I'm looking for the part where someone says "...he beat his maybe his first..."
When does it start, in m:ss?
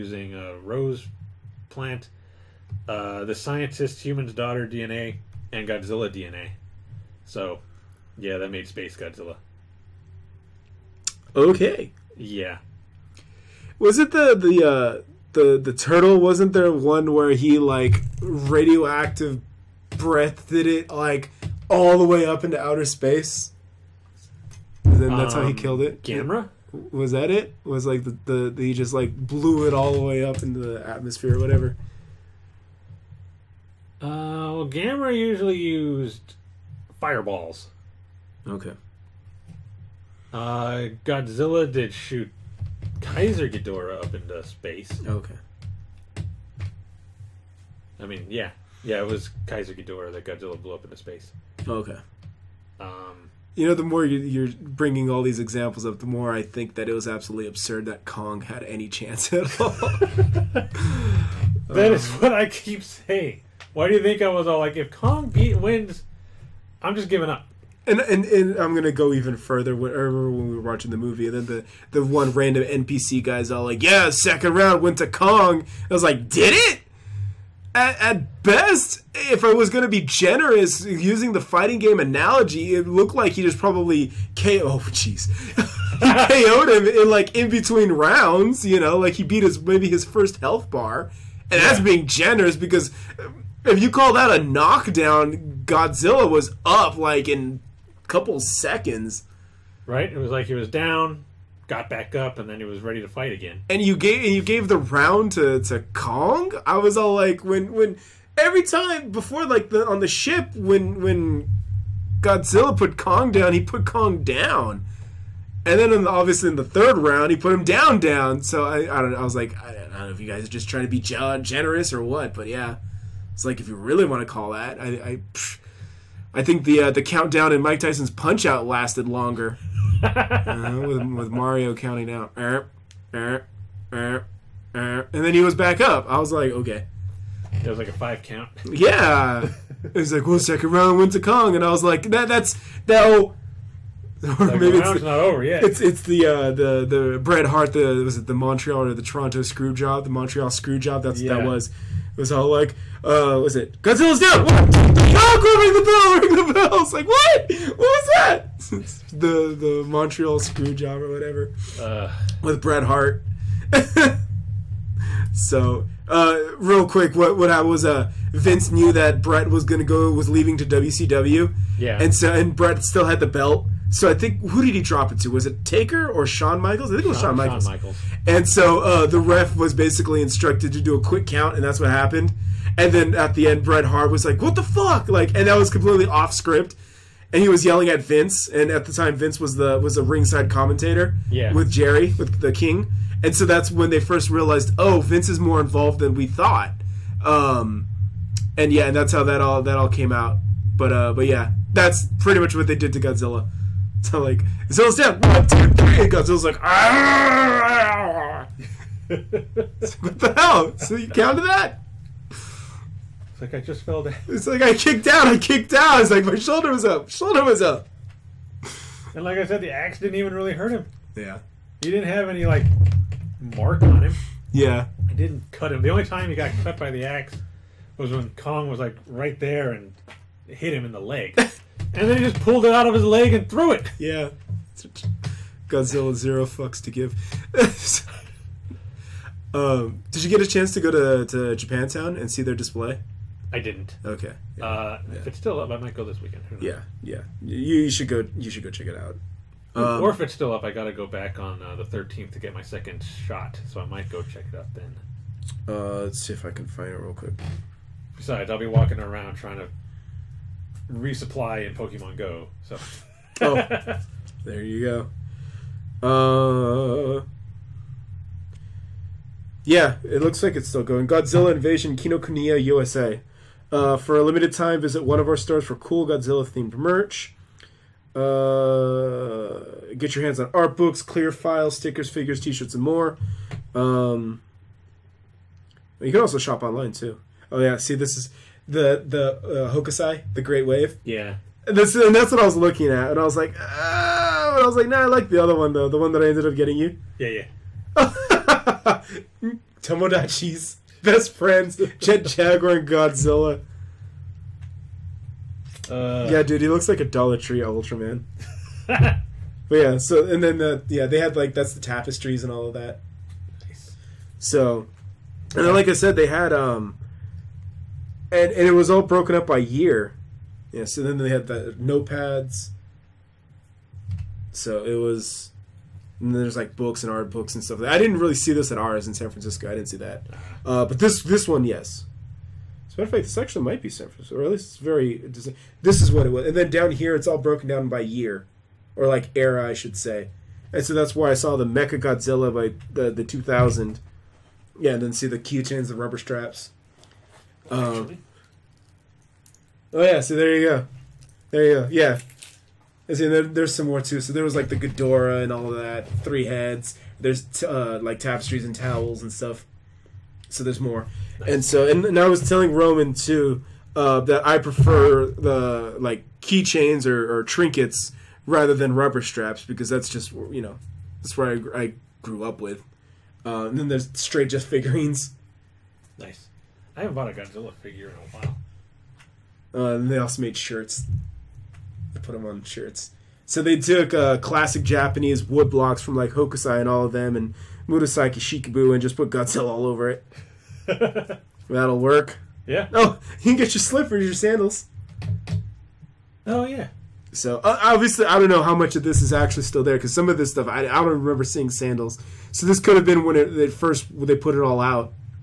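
1:29.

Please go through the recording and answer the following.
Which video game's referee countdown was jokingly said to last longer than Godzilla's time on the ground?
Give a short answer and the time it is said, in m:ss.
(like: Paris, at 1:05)
Mike Tyson's Punch Out, at 2:07.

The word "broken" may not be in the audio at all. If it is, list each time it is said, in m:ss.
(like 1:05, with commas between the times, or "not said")
5:19, 5:37.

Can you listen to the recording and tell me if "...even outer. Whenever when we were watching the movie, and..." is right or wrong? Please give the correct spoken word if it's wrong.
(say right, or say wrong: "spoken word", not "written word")
wrong: "further", not "outer".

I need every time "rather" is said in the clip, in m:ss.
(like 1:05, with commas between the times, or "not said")
6:08.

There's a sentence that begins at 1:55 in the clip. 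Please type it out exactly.
And then in the, obviously in the third round, he put him down, down.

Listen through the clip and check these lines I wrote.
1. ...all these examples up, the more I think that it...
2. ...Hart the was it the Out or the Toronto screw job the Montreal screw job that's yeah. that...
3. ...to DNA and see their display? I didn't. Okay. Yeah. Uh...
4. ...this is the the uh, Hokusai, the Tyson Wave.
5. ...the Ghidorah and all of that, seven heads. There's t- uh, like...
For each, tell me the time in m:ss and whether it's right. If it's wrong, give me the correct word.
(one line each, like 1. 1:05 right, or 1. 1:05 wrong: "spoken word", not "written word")
1. 0:55 right
2. 2:27 wrong: "Montreal", not "Out"
3. 4:01 wrong: "Japantown", not "DNA"
4. 4:47 wrong: "Great", not "Tyson"
5. 5:54 wrong: "three", not "seven".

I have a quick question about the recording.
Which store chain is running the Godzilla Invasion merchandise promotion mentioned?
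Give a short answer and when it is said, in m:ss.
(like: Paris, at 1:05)
Kinokuniya, at 4:31.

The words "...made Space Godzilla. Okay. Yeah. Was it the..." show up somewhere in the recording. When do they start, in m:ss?
0:08.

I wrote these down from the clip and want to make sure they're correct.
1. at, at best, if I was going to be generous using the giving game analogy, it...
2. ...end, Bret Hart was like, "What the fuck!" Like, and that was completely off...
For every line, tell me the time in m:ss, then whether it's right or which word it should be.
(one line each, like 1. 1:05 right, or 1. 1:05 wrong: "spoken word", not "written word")
1. 1:17 wrong: "fighting", not "giving"
2. 3:03 right.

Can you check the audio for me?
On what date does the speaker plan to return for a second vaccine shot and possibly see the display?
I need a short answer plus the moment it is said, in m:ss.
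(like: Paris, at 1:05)
the 13th, at 4:11.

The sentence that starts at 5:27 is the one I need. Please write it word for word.
I didn't really see this at ours in San Francisco.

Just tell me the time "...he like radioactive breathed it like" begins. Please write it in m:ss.
0:17.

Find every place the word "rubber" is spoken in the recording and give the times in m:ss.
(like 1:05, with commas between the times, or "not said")
5:45, 6:08.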